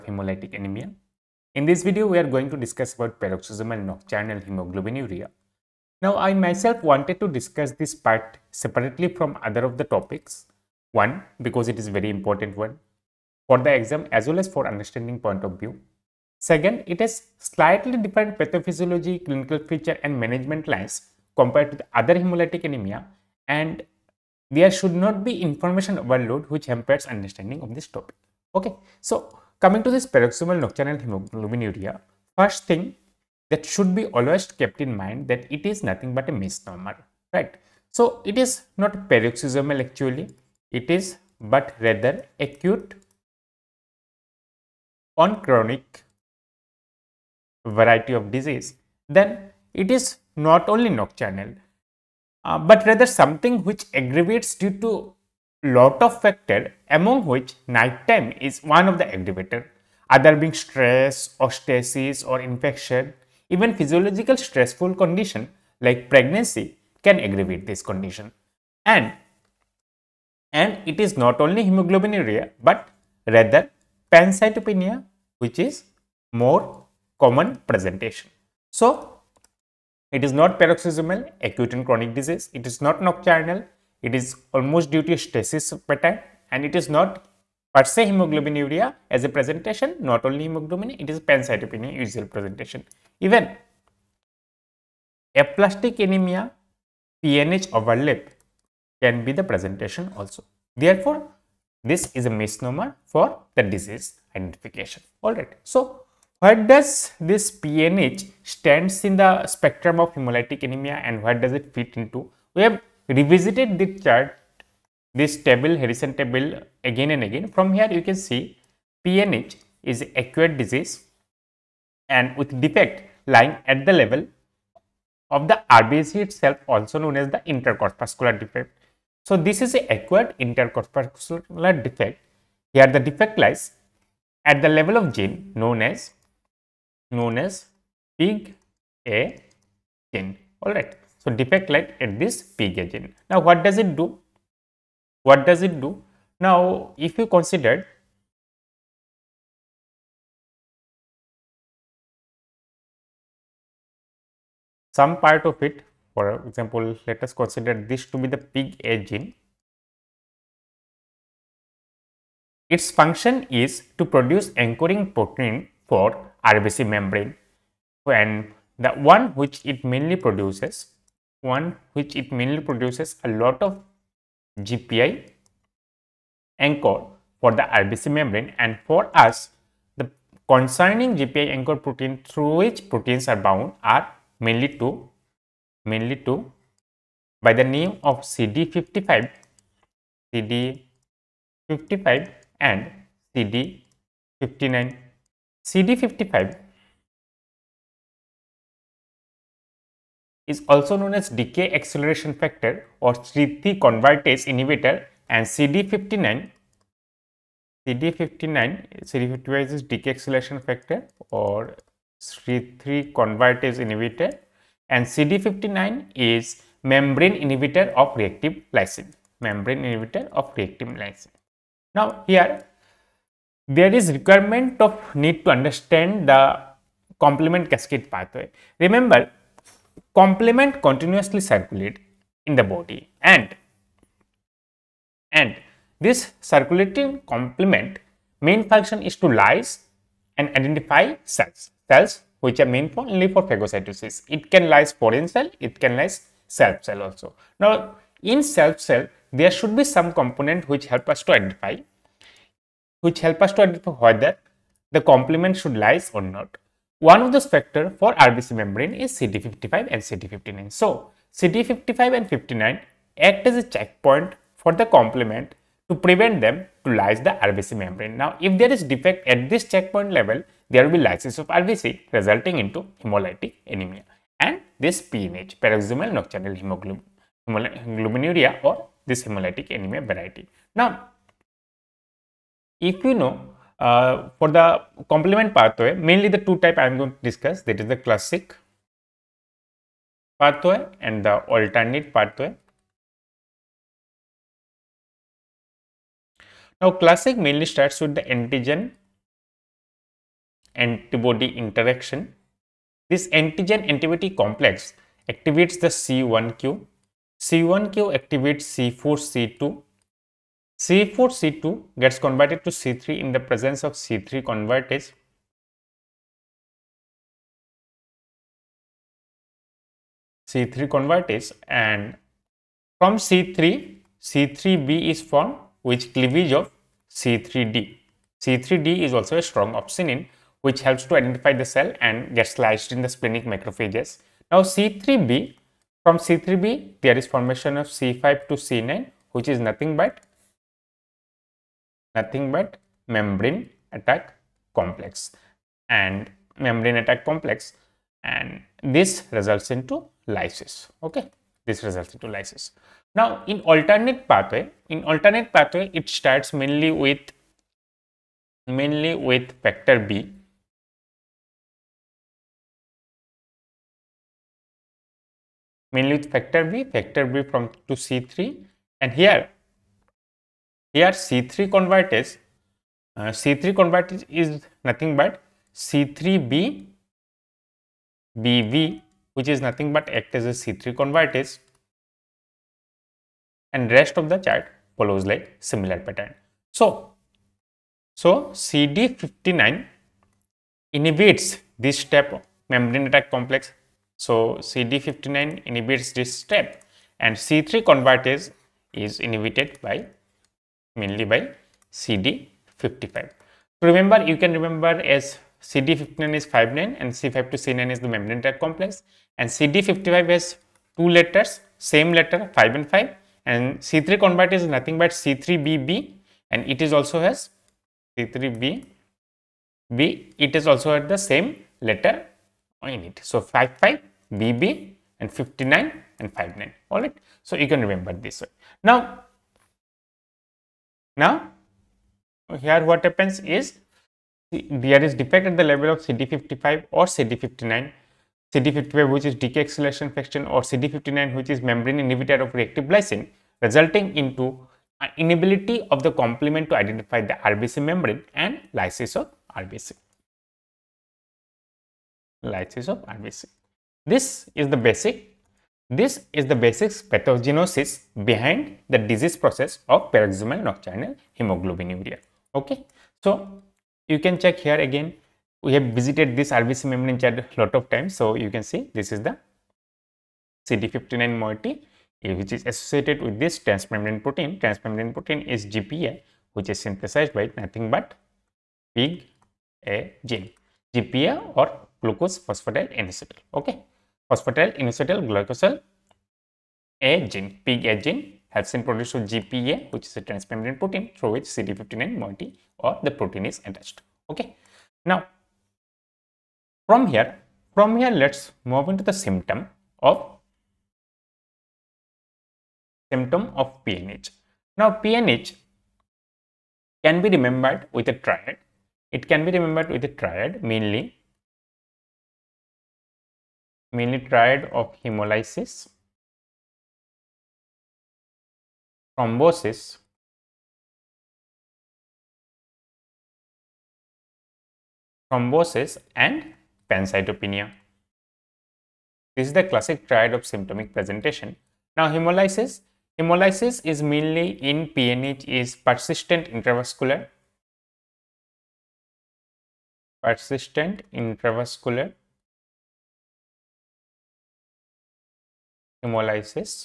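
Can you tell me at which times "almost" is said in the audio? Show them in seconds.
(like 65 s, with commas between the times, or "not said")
84 s.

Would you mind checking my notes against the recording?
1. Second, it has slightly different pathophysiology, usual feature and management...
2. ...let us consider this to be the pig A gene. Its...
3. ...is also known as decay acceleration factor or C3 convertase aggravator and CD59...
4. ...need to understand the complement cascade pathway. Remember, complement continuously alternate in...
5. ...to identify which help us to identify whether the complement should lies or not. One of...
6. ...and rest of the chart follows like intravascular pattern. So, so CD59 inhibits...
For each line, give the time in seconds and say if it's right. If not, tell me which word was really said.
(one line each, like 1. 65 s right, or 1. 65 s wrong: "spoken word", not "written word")
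1. 16 s wrong: "clinical", not "usual"
2. 157 s right
3. 200 s wrong: "inhibitor", not "aggravator"
4. 225 s wrong: "circulate", not "alternate"
5. 251 s right
6. 383 s wrong: "similar", not "intravascular".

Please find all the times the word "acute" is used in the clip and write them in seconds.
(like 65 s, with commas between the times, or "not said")
42 s, 81 s, 120 s.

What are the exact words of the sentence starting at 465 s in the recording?
We have visited this RBC membrane chart a lot of times.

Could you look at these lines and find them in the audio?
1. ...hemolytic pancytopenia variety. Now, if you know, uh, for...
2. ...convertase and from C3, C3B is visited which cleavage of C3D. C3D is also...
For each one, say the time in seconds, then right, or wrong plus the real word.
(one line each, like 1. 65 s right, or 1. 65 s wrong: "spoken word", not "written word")
1. 279 s wrong: "anemia", not "pancytopenia"
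2. 320 s wrong: "formed", not "visited".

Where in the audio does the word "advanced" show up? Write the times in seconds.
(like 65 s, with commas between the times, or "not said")
not said.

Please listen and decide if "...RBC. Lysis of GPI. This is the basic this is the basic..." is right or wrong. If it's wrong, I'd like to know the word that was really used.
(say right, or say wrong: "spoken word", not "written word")
wrong: "RBC", not "GPI".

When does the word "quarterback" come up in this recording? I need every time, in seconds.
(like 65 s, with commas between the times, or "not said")
not said.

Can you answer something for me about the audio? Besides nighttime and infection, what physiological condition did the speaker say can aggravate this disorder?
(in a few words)
Pregnancy.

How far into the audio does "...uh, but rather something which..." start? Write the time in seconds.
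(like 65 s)
52 s.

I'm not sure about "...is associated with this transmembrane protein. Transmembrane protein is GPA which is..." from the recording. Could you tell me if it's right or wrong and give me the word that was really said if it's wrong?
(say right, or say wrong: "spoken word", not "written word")
right.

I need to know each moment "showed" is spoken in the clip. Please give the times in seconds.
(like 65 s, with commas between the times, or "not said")
not said.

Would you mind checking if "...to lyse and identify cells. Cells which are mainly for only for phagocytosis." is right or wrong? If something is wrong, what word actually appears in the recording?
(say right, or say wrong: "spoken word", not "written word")
right.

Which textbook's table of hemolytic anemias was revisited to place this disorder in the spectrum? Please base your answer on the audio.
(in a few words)
Harrison.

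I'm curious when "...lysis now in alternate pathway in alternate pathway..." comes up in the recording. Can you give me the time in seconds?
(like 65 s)
352 s.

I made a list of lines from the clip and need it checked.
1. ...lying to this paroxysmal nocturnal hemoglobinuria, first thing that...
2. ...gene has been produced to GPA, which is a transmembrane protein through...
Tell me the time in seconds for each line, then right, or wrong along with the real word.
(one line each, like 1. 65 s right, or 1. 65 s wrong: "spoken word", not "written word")
1. 29 s wrong: "coming", not "lying"
2. 488 s right.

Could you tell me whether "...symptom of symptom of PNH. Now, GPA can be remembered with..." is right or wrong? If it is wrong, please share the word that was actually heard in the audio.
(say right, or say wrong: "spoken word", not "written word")
wrong: "PNH", not "GPA".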